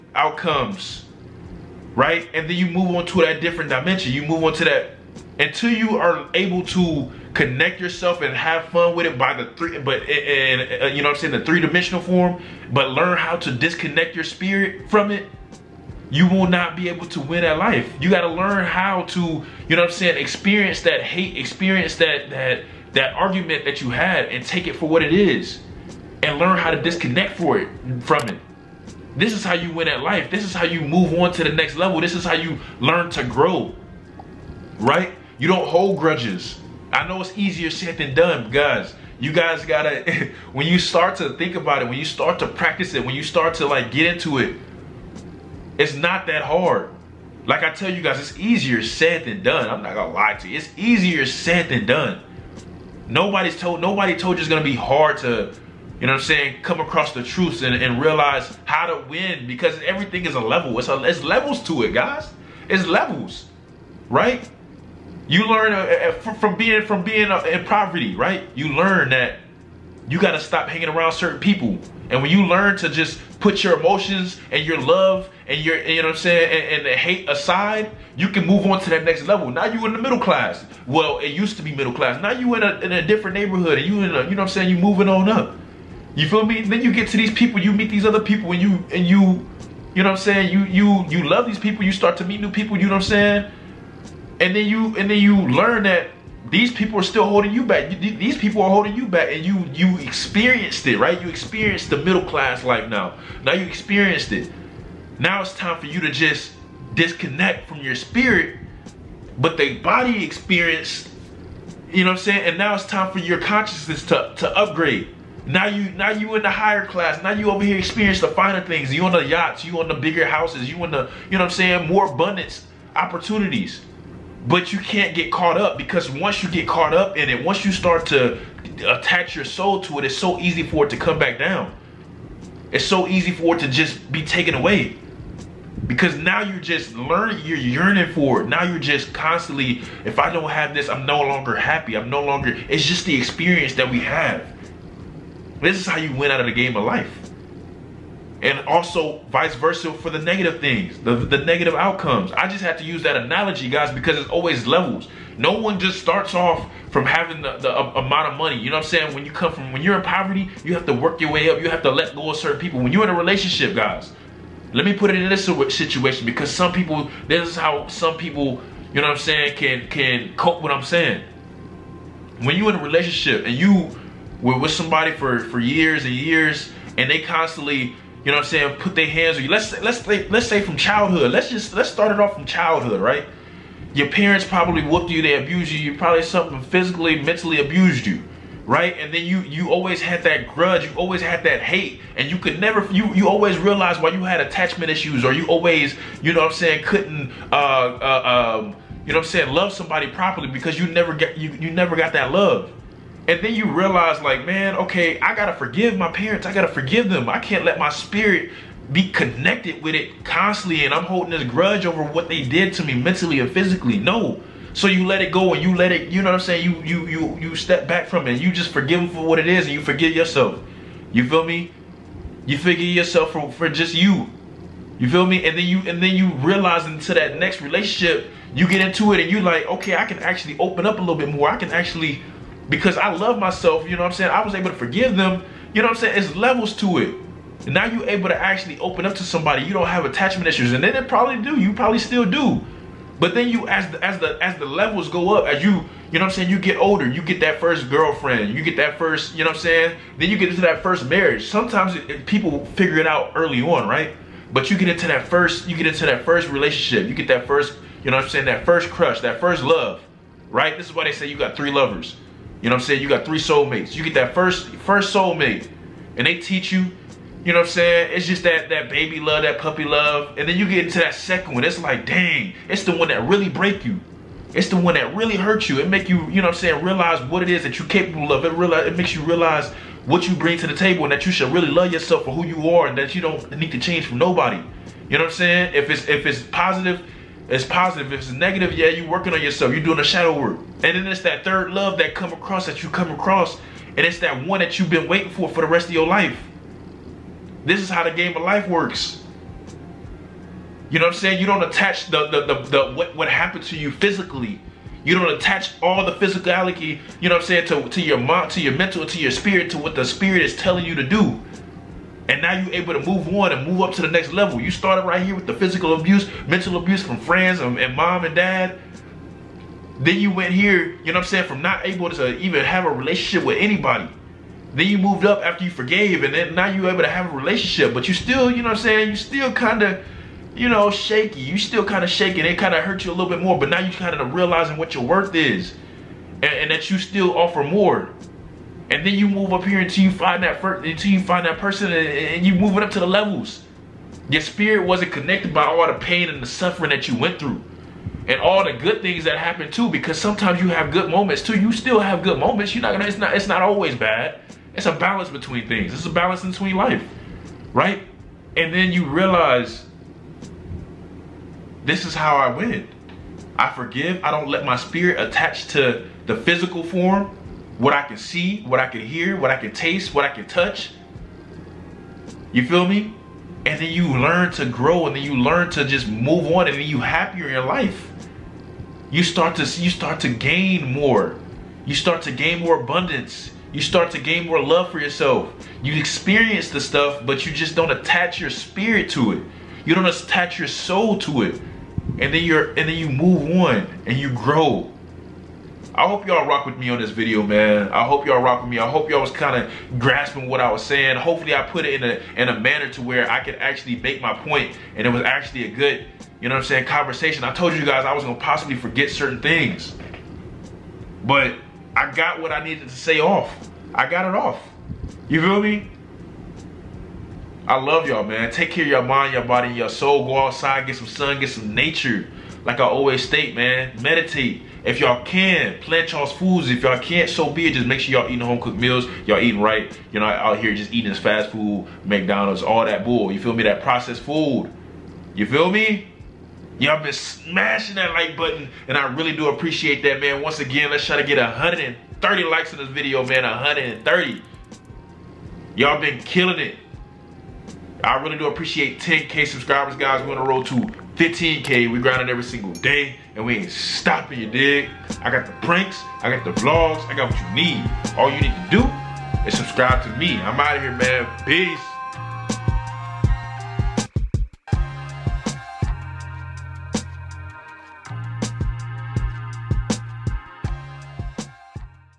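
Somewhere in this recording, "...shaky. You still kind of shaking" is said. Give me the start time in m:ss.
5:30.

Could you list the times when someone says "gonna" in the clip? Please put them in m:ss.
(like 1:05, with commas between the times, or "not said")
0:49, 0:54, 5:52, 6:48.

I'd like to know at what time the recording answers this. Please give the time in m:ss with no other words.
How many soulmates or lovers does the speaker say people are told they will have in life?
4:21.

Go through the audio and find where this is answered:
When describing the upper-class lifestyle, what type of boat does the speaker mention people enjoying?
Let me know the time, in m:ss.
1:59.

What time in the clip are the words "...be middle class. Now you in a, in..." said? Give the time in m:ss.
1:21.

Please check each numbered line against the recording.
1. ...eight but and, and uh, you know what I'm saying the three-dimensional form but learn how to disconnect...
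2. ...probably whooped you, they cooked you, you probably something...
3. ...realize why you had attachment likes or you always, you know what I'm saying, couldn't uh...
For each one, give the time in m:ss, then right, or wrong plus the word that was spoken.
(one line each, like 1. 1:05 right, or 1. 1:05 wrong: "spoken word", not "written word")
1. 0:09 wrong: "three", not "eight"
2. 3:04 wrong: "abused", not "cooked"
3. 3:13 wrong: "issues", not "likes".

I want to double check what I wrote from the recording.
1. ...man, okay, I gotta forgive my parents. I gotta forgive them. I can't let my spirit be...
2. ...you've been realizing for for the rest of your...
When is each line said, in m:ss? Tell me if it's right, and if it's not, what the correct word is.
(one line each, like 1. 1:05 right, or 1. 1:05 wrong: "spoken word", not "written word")
1. 3:24 right
2. 4:54 wrong: "waiting", not "realizing".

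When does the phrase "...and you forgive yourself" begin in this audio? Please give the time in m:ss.
3:39.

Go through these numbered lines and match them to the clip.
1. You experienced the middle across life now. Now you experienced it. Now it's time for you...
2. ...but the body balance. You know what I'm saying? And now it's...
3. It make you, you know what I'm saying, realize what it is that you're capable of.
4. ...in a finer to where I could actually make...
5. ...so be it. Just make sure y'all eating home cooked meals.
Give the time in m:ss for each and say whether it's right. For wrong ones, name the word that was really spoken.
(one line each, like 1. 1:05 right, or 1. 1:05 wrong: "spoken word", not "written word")
1. 1:41 wrong: "class", not "across"
2. 1:49 wrong: "experience", not "balance"
3. 4:35 right
4. 6:42 wrong: "manner", not "finer"
5. 7:07 right.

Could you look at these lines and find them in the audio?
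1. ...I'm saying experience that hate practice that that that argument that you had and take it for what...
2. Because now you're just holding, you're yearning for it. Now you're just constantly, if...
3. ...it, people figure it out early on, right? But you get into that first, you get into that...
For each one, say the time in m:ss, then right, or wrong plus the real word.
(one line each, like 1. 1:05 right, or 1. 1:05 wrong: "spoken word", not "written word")
1. 0:19 wrong: "experience", not "practice"
2. 2:15 wrong: "learning", not "holding"
3. 4:12 right.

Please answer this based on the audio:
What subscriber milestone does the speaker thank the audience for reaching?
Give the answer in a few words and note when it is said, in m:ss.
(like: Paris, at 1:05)
10K, at 7:29.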